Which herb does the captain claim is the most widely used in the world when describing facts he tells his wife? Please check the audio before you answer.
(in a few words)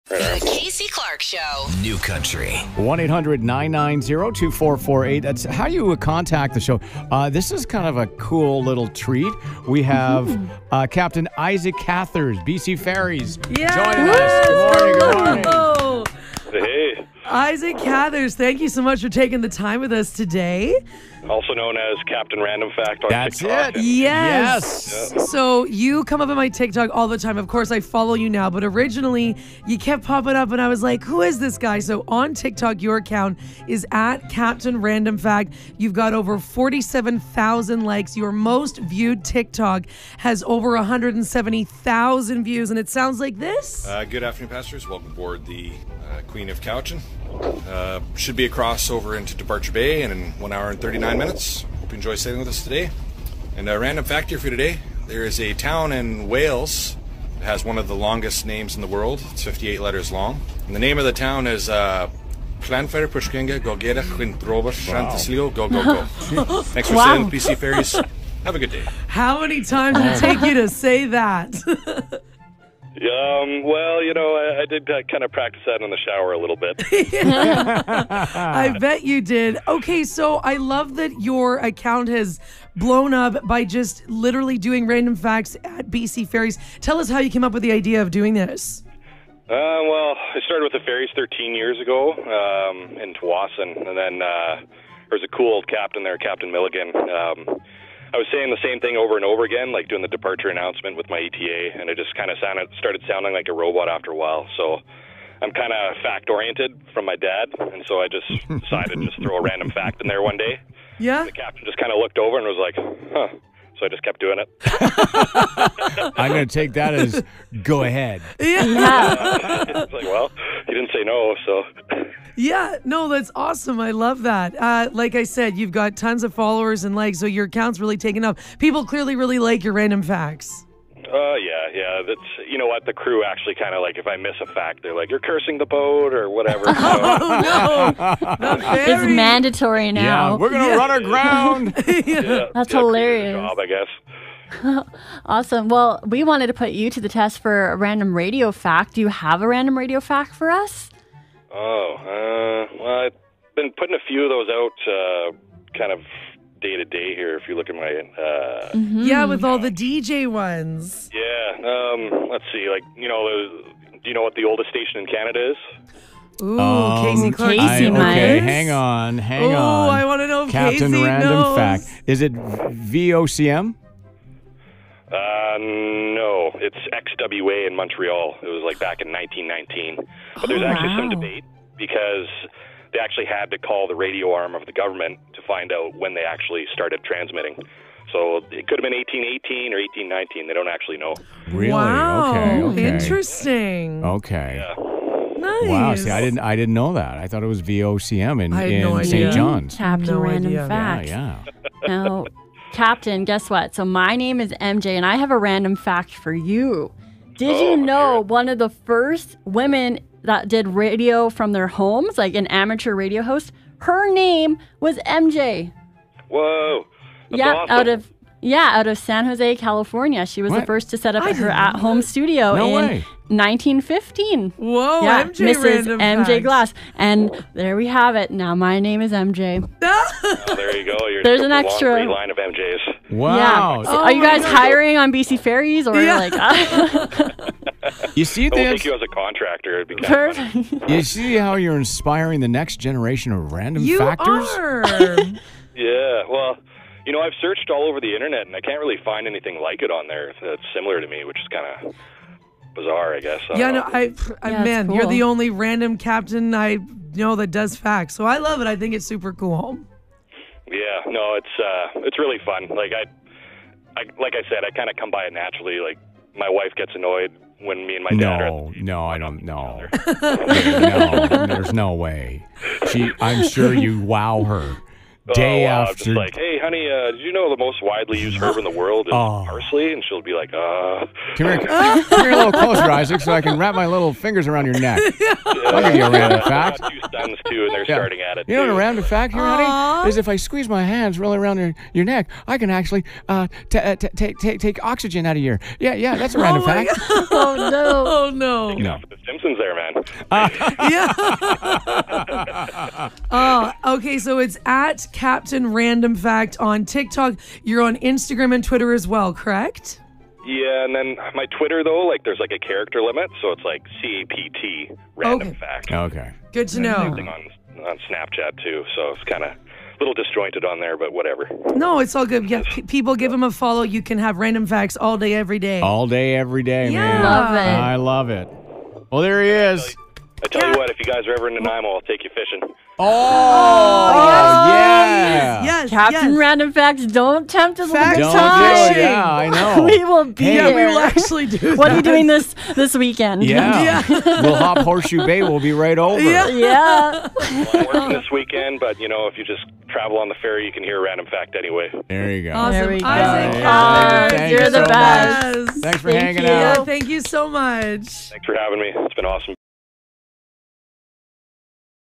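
Parsley.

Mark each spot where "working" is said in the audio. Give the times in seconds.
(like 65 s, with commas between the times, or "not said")
347 s.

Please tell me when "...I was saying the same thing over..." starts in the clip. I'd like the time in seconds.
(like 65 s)
98 s.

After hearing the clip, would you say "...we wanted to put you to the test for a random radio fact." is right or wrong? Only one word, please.
right.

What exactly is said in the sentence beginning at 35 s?
You've got over forty-seven thousand likes.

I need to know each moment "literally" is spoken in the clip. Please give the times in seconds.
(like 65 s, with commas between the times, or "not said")
84 s.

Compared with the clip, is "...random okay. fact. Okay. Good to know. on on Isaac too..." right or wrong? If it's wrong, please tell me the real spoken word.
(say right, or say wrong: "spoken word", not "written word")
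wrong: "Snapchat", not "Isaac".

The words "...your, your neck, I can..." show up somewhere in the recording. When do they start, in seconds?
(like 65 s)
291 s.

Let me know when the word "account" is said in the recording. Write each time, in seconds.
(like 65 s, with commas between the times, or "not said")
32 s, 81 s, 127 s.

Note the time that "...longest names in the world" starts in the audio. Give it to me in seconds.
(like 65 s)
57 s.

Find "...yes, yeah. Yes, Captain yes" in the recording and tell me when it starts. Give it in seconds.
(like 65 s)
334 s.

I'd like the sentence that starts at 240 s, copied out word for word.
you see how you're inspiring the next generation of random you factors.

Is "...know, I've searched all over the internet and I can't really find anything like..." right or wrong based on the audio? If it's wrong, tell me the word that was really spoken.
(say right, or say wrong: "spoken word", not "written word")
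right.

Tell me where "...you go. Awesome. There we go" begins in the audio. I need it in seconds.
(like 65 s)
352 s.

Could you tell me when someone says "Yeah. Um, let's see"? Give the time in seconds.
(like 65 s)
161 s.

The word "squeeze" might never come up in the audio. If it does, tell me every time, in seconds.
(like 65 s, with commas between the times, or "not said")
290 s.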